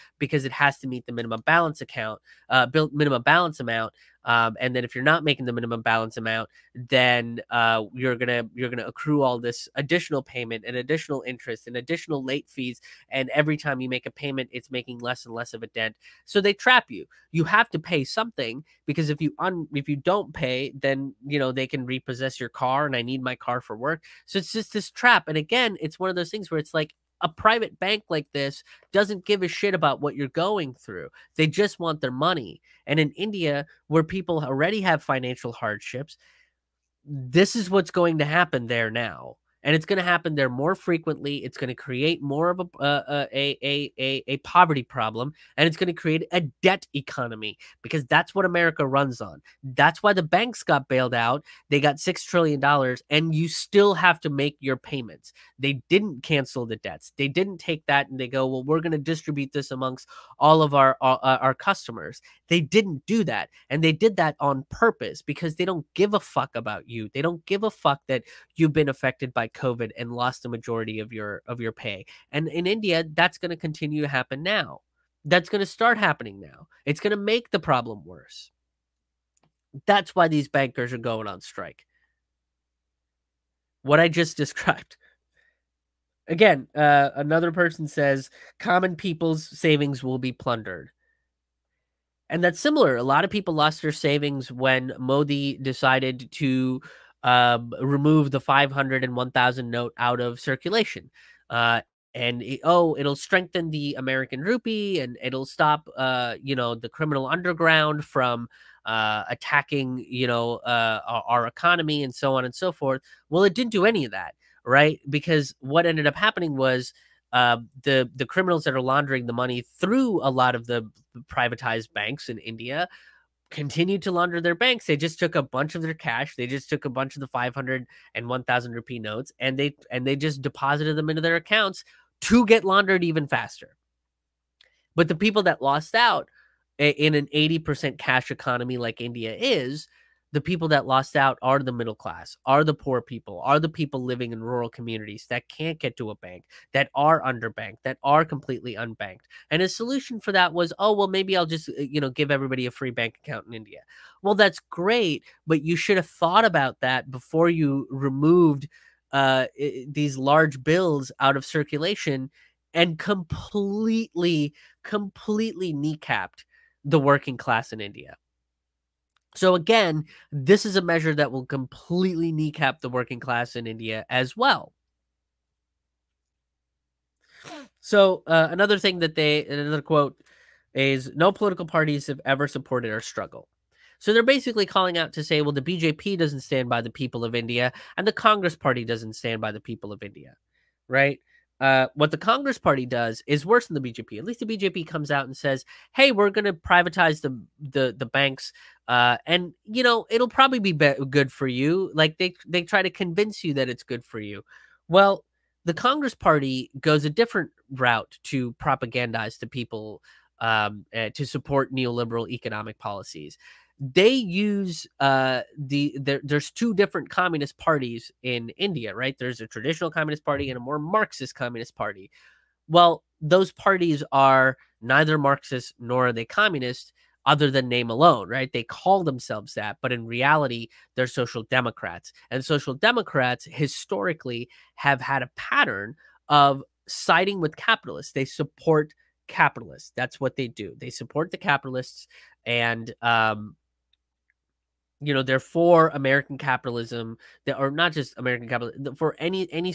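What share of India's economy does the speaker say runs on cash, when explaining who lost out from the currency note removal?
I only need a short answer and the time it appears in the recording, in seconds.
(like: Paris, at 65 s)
80%, at 137 s.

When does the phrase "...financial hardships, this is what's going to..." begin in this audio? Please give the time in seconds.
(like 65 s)
35 s.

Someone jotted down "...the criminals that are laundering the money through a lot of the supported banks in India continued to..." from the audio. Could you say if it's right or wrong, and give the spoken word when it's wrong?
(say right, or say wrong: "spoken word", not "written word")
wrong: "privatized", not "supported".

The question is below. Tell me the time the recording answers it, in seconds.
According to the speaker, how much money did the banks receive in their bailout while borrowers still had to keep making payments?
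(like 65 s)
51 s.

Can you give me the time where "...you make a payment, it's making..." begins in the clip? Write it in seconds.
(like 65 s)
13 s.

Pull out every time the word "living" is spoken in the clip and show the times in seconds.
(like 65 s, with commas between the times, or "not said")
144 s.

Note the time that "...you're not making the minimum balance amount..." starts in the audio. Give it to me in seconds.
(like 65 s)
4 s.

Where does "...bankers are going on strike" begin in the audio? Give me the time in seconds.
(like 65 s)
80 s.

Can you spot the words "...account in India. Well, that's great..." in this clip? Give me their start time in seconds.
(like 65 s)
153 s.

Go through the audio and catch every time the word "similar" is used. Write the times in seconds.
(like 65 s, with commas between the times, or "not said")
92 s.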